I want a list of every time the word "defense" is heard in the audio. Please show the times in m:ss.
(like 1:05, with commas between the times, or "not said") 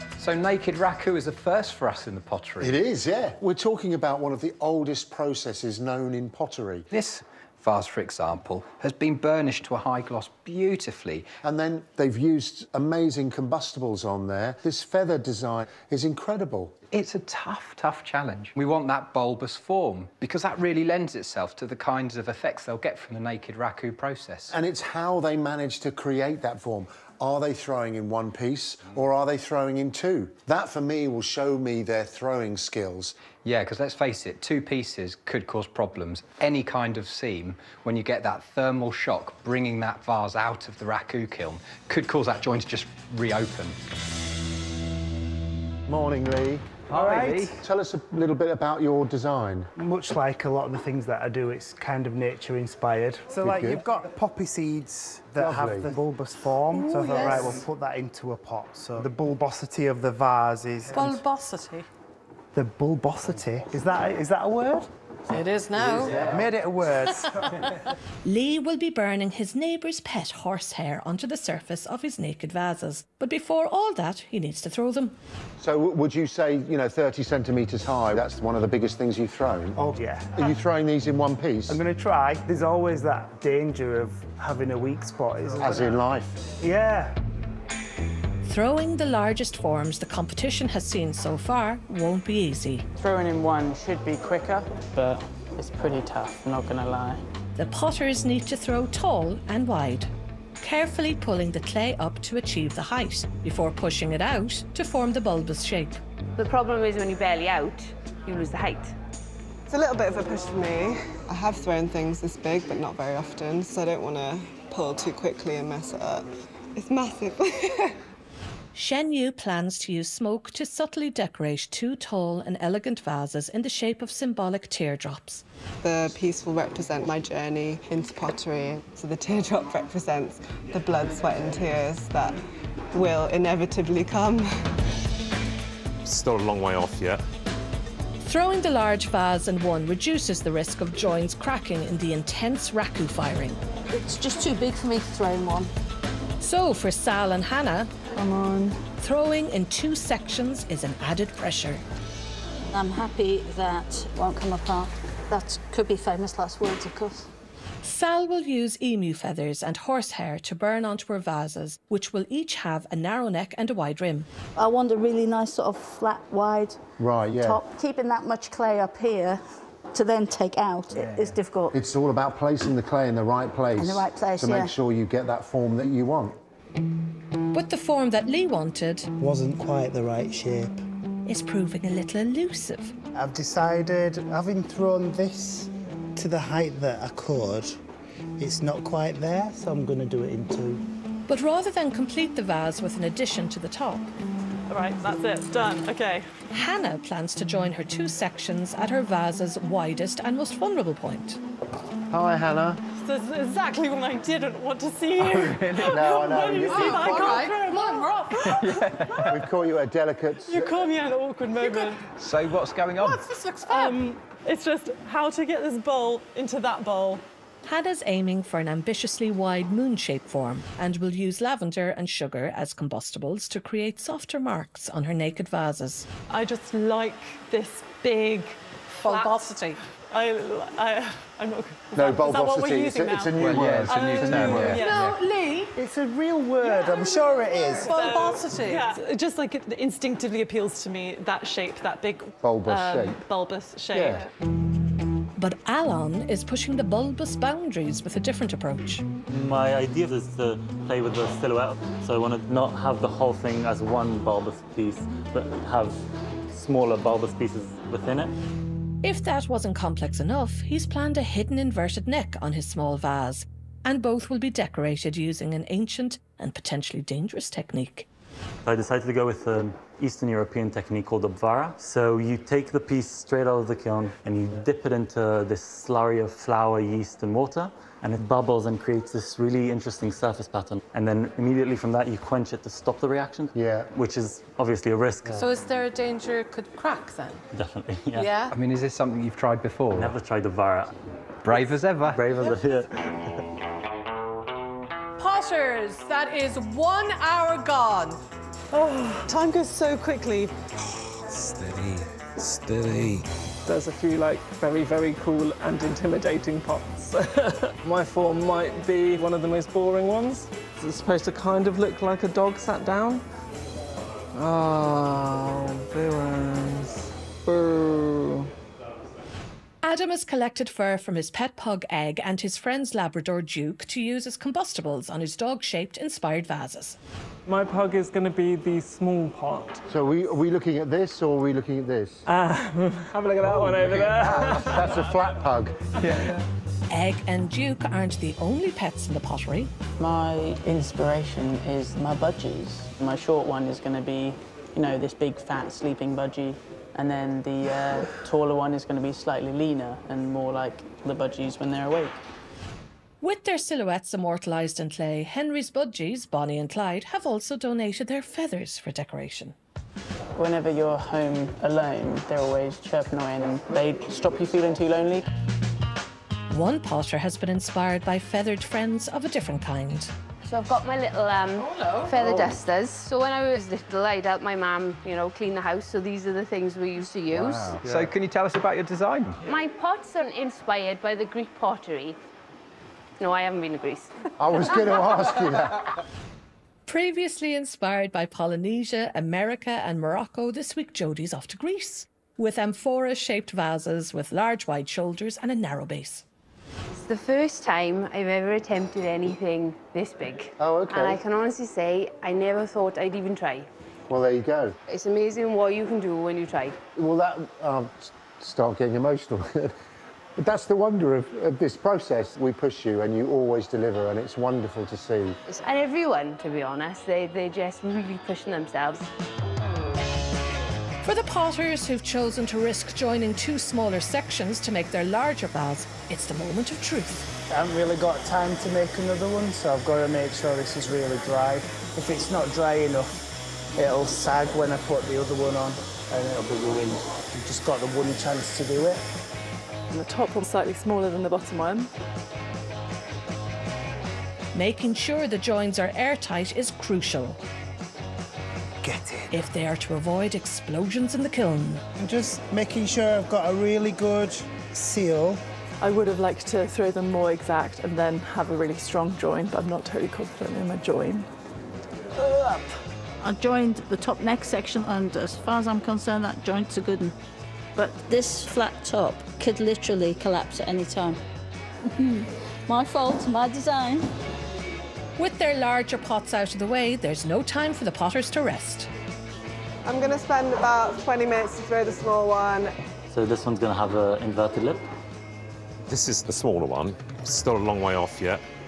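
not said.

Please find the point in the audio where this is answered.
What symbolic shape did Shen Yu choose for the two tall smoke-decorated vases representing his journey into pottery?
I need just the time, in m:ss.
2:04.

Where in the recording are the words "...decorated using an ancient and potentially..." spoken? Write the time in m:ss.
4:24.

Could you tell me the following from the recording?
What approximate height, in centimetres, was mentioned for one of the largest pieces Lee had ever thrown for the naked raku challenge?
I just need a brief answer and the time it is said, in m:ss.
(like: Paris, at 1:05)
30, at 1:16.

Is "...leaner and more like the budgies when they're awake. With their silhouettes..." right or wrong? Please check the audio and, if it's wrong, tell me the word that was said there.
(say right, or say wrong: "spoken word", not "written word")
right.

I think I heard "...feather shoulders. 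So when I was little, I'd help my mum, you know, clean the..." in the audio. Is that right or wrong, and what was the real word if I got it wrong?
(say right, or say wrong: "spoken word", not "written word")
wrong: "dusters", not "shoulders".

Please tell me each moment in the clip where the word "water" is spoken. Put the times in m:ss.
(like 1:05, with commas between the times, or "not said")
4:37.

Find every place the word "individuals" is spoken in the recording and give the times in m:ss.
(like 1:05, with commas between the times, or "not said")
not said.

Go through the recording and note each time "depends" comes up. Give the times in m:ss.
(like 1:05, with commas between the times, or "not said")
not said.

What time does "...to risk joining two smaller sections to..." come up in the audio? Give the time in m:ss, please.
7:02.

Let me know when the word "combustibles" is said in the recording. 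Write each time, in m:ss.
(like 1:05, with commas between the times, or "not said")
0:13, 3:42, 5:24.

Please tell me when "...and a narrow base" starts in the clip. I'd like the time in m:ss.
6:35.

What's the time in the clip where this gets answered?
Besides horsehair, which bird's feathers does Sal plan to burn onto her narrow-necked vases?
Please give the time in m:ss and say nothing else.
2:38.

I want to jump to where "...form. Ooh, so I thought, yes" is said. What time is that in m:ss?
0:56.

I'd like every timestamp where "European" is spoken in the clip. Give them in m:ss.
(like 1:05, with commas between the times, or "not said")
4:30.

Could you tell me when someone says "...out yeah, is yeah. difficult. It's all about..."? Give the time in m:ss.
2:50.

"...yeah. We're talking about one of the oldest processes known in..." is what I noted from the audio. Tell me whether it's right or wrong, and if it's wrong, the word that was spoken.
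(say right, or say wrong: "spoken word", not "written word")
right.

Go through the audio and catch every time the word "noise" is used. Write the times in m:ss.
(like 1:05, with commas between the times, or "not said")
not said.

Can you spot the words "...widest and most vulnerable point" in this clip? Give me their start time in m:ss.
3:19.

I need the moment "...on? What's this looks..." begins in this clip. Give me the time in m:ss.
3:32.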